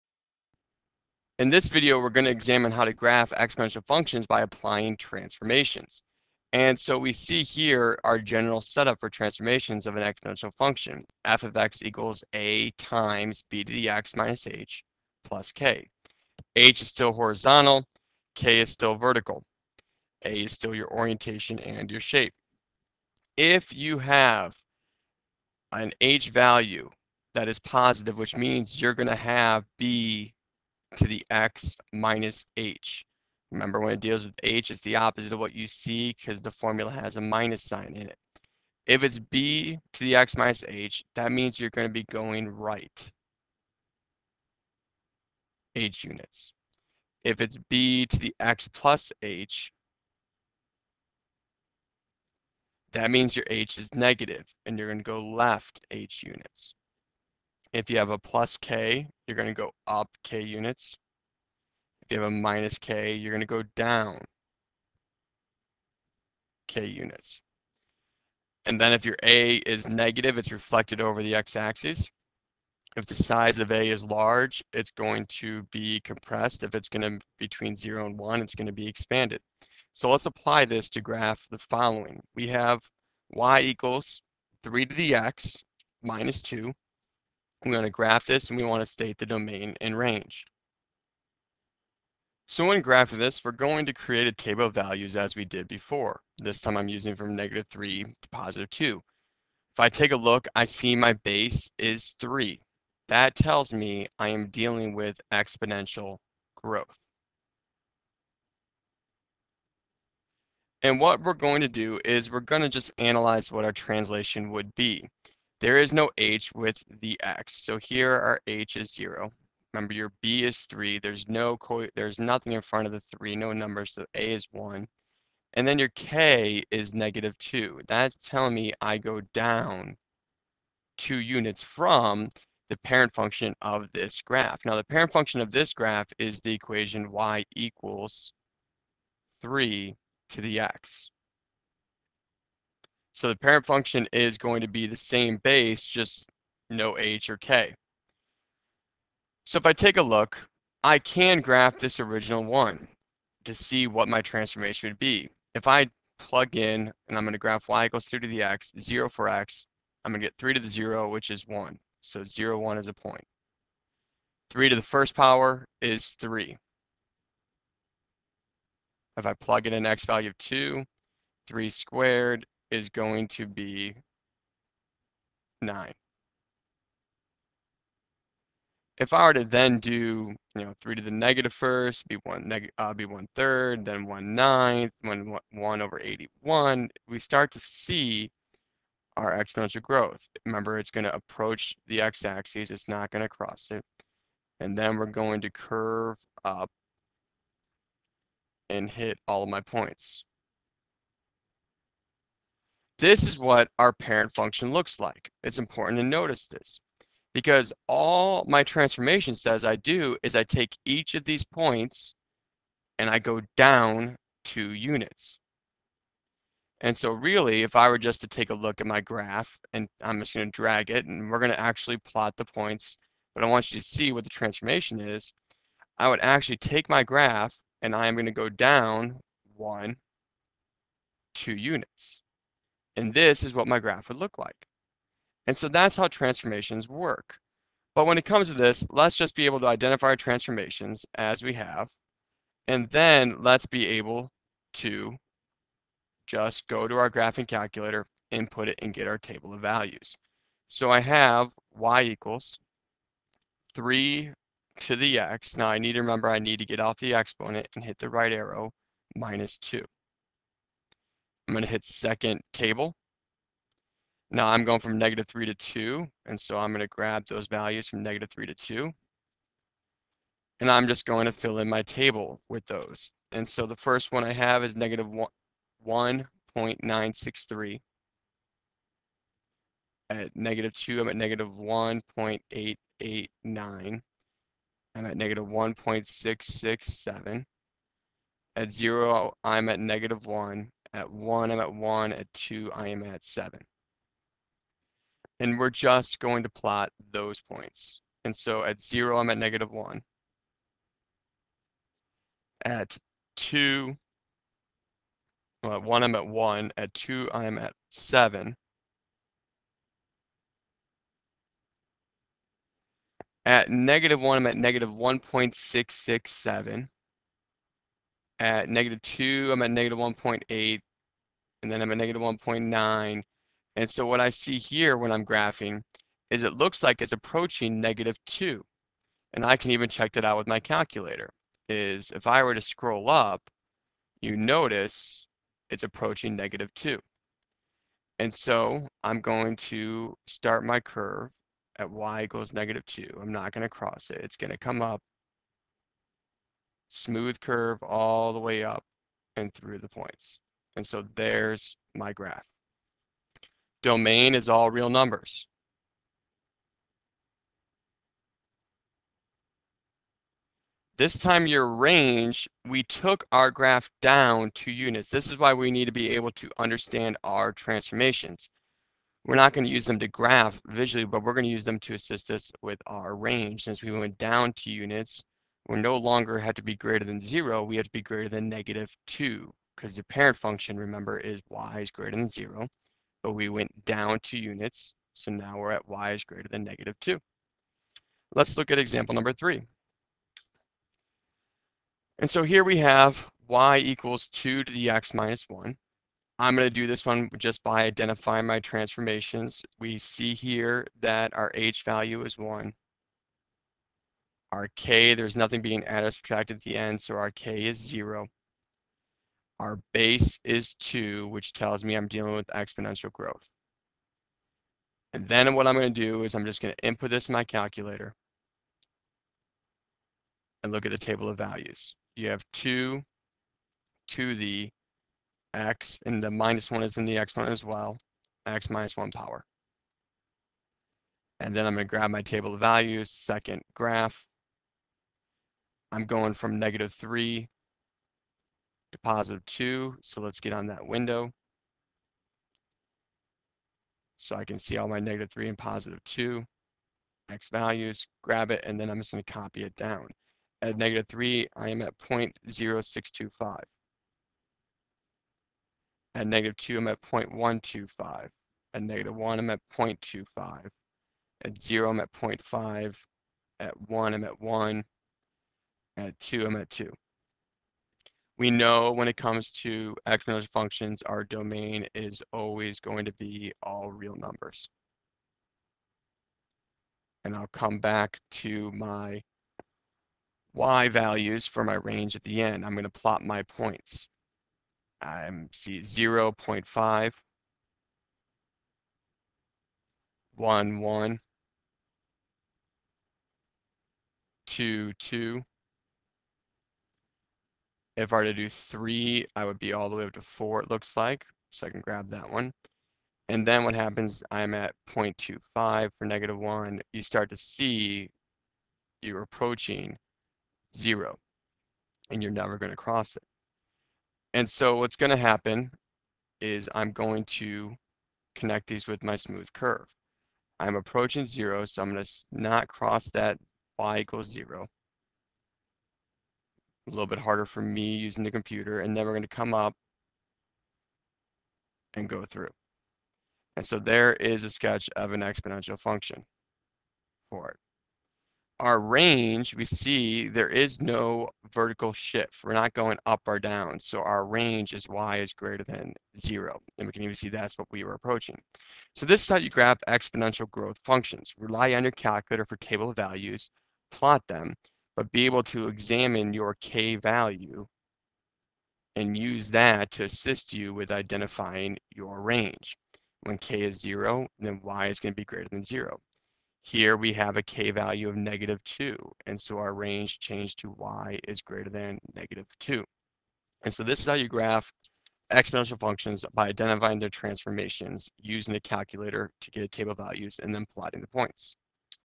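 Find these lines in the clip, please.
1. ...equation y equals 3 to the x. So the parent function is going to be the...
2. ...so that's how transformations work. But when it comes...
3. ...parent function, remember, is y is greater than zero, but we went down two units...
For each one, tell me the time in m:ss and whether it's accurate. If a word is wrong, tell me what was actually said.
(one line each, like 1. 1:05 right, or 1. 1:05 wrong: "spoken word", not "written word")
1. 2:16 right
2. 3:55 right
3. 6:20 right.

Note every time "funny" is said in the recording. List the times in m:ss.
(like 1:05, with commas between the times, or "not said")
not said.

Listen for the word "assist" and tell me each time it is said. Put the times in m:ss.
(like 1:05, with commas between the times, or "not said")
6:11, 9:20.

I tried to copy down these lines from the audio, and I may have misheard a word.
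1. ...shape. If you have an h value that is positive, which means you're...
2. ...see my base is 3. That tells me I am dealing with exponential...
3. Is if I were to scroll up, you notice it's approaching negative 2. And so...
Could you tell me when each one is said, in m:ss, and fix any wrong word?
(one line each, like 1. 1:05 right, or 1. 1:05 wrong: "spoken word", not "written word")
1. 0:22 right
2. 1:40 right
3. 5:31 right.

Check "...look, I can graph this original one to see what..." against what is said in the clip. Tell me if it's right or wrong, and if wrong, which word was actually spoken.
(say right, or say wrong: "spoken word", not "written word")
right.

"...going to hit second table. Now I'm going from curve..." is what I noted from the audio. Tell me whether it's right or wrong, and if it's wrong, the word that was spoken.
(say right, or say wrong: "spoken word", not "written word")
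wrong: "negative", not "curve".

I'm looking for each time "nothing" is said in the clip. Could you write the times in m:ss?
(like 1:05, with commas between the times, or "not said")
2:02, 6:45.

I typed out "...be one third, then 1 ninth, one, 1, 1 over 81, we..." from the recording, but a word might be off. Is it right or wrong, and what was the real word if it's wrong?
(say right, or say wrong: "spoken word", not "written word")
right.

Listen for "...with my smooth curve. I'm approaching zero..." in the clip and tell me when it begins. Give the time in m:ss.
8:38.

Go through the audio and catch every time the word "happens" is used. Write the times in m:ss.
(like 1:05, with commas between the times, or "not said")
8:23, 8:35.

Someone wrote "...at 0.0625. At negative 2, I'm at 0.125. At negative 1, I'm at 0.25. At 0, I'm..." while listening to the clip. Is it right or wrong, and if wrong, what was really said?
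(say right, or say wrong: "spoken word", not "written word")
right.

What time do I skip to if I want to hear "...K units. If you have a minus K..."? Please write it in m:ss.
1:00.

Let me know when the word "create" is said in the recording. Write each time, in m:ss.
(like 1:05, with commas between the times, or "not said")
1:33.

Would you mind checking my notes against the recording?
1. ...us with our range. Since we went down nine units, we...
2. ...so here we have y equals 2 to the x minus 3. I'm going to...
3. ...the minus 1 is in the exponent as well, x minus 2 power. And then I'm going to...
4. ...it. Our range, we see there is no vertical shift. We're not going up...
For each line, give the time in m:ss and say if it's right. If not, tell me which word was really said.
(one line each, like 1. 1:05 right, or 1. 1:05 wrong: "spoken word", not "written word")
1. 6:12 wrong: "two", not "nine"
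2. 6:32 wrong: "1", not "3"
3. 7:06 wrong: "1", not "2"
4. 8:57 right.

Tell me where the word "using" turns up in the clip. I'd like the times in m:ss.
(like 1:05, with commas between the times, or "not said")
1:36, 8:47, 9:38.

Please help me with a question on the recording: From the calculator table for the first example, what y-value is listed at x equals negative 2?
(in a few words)
-1.889.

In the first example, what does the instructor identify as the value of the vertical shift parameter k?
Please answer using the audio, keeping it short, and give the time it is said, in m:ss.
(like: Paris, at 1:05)
-2, at 2:05.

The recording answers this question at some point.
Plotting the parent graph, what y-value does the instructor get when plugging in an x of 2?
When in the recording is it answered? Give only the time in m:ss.
2:55.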